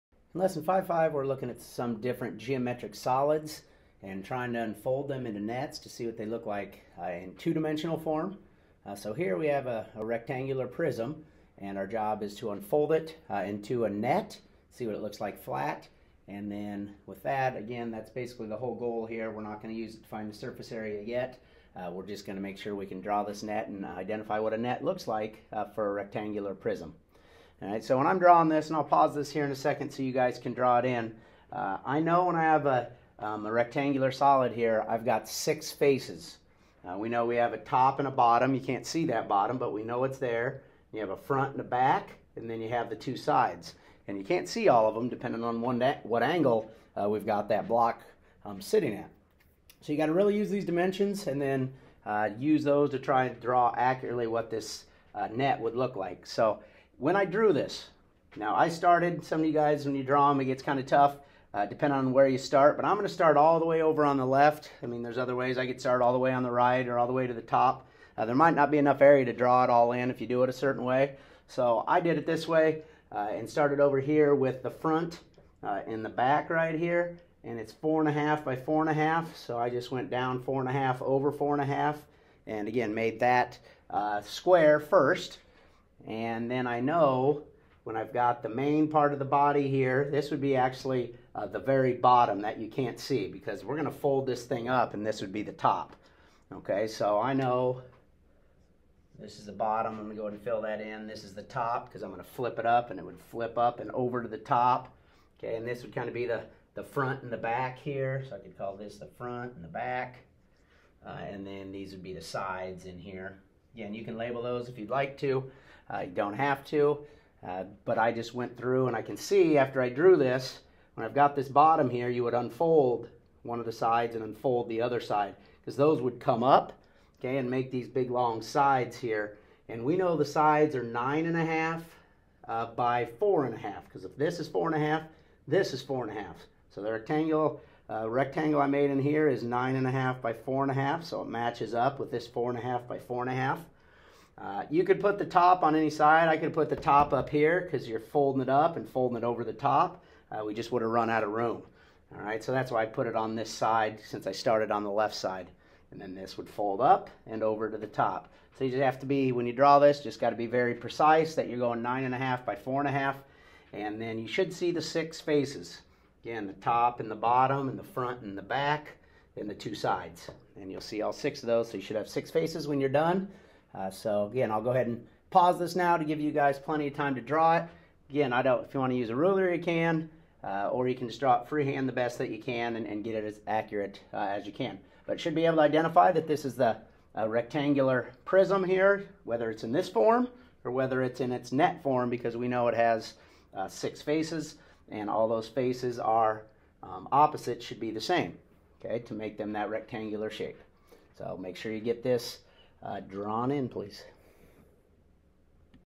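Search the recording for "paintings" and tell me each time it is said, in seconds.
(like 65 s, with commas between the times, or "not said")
not said.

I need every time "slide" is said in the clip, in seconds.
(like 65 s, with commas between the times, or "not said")
not said.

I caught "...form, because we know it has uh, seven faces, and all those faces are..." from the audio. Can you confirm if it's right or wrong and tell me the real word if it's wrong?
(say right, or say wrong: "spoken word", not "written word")
wrong: "six", not "seven".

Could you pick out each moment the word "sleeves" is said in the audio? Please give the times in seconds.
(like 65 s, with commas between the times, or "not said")
not said.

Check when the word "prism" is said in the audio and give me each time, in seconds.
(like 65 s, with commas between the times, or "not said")
10 s, 26 s, 188 s.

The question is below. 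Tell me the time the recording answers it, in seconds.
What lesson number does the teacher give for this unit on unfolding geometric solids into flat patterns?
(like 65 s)
0 s.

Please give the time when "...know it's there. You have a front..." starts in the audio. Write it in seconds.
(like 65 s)
39 s.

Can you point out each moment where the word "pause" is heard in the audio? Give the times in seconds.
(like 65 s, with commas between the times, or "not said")
28 s, 175 s.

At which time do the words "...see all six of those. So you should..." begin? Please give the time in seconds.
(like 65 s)
170 s.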